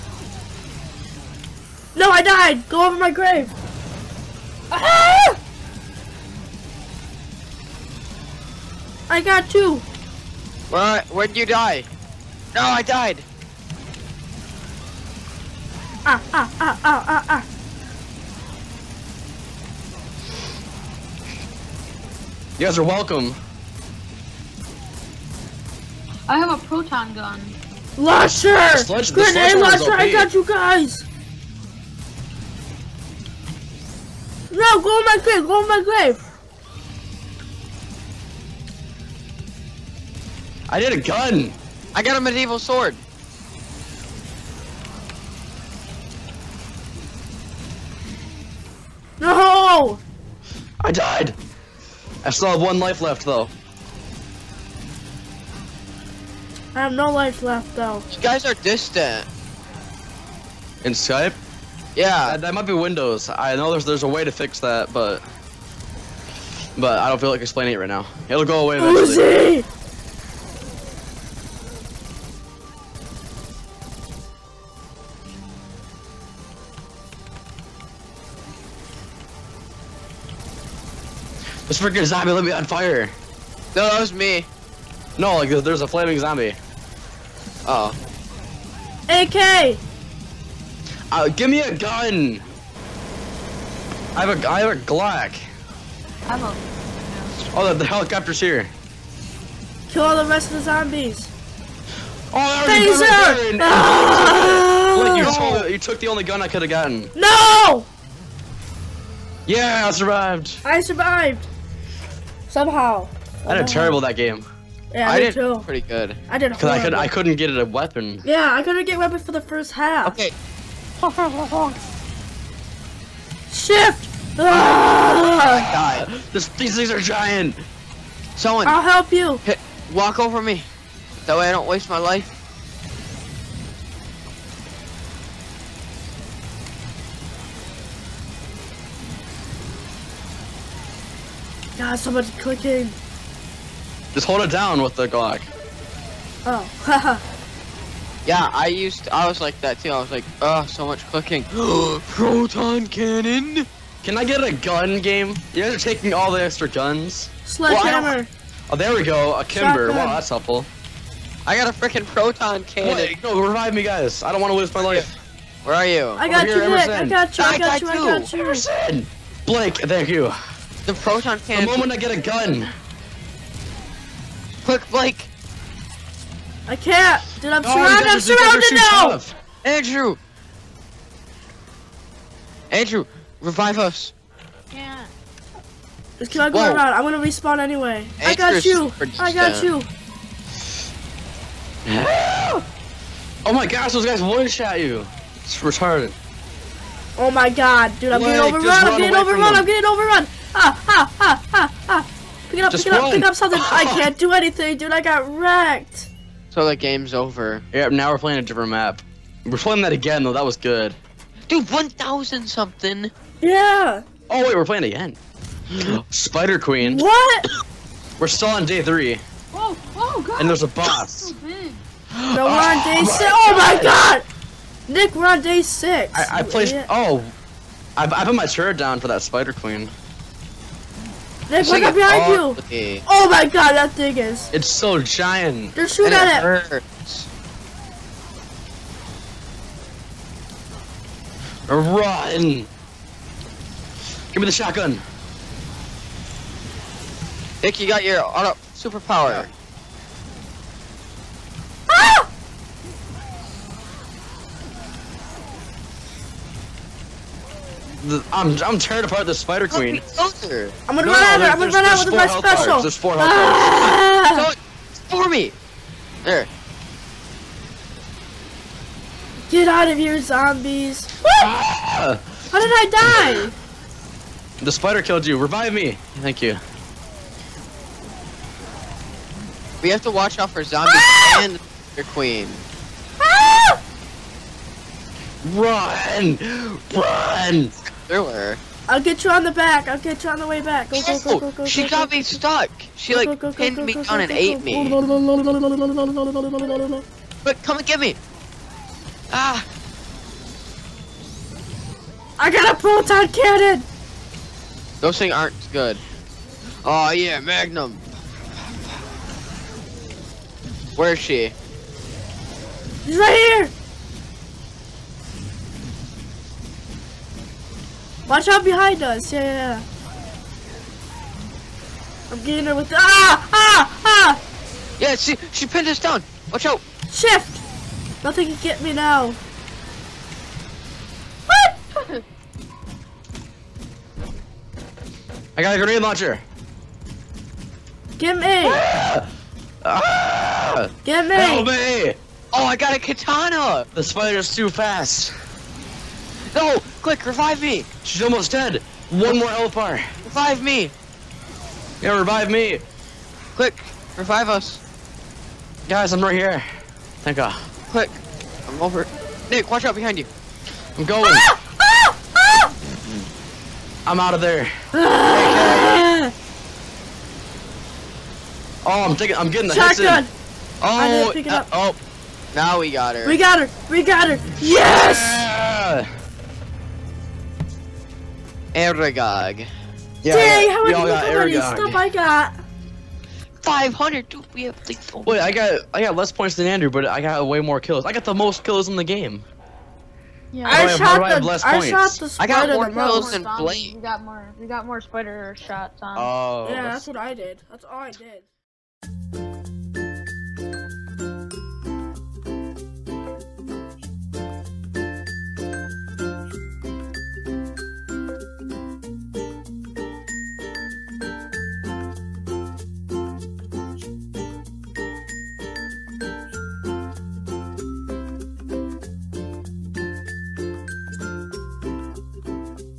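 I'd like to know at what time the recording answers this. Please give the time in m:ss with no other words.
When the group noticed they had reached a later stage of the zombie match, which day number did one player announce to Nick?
3:45.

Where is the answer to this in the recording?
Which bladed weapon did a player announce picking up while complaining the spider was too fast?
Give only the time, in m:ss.
5:42.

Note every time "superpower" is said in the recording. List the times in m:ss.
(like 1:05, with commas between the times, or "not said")
4:08.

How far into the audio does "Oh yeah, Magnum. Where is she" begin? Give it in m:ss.
5:06.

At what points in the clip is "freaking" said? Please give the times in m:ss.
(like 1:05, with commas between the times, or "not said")
1:21, 2:41.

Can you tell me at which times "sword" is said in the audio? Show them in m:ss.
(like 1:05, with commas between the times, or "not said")
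0:42.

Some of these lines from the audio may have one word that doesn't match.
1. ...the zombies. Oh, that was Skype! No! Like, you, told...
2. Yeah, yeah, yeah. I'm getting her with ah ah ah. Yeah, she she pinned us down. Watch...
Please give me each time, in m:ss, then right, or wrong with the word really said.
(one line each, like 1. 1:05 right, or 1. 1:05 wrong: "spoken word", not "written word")
1. 1:40 wrong: "Taser", not "Skype"
2. 5:19 right.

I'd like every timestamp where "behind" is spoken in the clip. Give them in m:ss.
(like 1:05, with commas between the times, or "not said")
3:51, 5:18, 5:59.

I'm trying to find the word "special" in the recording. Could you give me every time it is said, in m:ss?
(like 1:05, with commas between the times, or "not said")
4:22.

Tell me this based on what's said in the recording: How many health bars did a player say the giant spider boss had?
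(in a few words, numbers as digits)
4.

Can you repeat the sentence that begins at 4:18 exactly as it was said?
I'm I'm tearing apart the spider queen.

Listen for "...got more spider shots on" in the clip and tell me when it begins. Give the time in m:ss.
6:34.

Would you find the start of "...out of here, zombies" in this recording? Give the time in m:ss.
4:29.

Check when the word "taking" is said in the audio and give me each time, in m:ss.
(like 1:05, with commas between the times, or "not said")
2:35, 6:09.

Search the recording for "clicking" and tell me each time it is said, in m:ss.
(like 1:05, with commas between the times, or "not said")
2:22, 2:31.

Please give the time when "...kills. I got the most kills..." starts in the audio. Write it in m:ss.
6:27.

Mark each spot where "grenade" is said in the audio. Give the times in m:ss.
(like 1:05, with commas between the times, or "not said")
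0:29, 5:35.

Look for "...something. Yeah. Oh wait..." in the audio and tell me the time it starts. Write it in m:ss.
3:32.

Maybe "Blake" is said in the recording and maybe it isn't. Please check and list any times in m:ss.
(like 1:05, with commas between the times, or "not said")
2:49, 2:54, 6:33.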